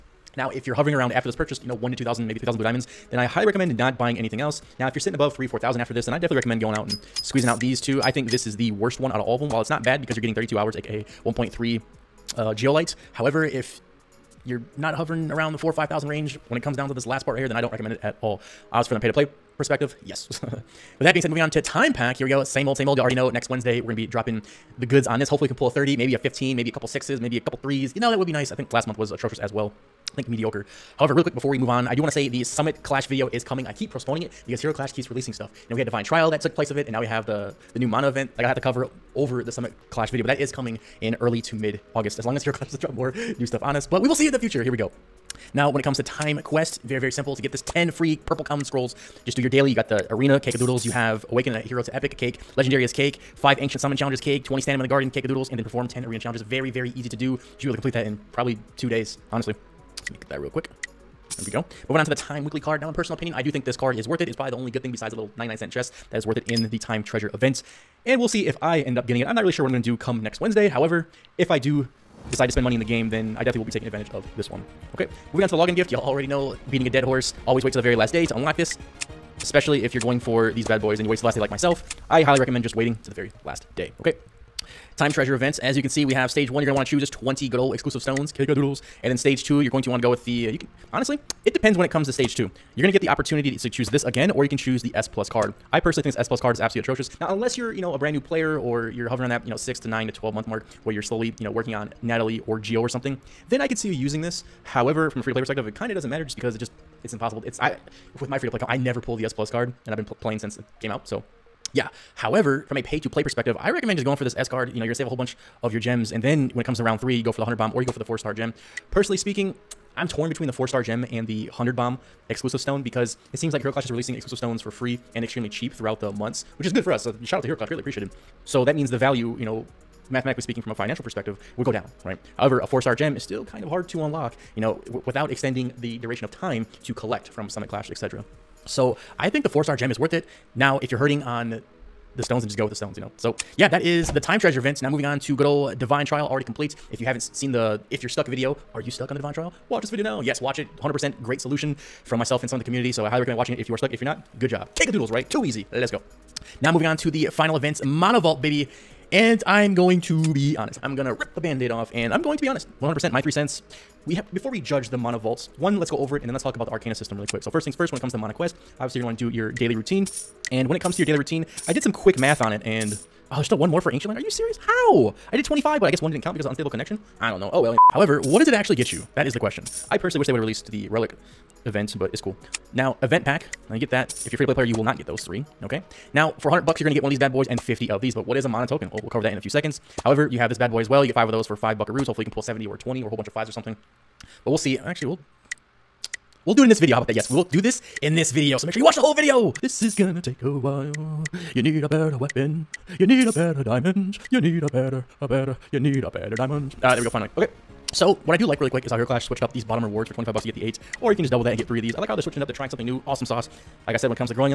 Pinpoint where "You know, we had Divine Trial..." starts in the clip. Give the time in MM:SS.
00:35.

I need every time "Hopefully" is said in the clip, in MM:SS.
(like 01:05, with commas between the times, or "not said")
00:25, 03:12.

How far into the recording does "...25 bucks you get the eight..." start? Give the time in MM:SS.
03:30.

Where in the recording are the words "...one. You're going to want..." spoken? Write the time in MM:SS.
01:26.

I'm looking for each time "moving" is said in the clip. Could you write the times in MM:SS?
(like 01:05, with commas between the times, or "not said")
00:21, 01:01, 01:15, 02:24, 02:36.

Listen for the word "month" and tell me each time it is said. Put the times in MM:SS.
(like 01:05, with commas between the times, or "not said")
00:28, 01:40, 02:06.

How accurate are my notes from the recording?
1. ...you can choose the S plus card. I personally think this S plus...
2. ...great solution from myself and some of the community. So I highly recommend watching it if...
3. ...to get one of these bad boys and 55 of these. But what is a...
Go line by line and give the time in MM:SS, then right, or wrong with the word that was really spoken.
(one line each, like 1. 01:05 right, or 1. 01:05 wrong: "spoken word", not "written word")
1. 01:34 right
2. 02:31 right
3. 03:06 wrong: "50", not "55".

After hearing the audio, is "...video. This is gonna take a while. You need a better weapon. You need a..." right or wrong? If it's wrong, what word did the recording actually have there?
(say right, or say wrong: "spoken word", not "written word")
right.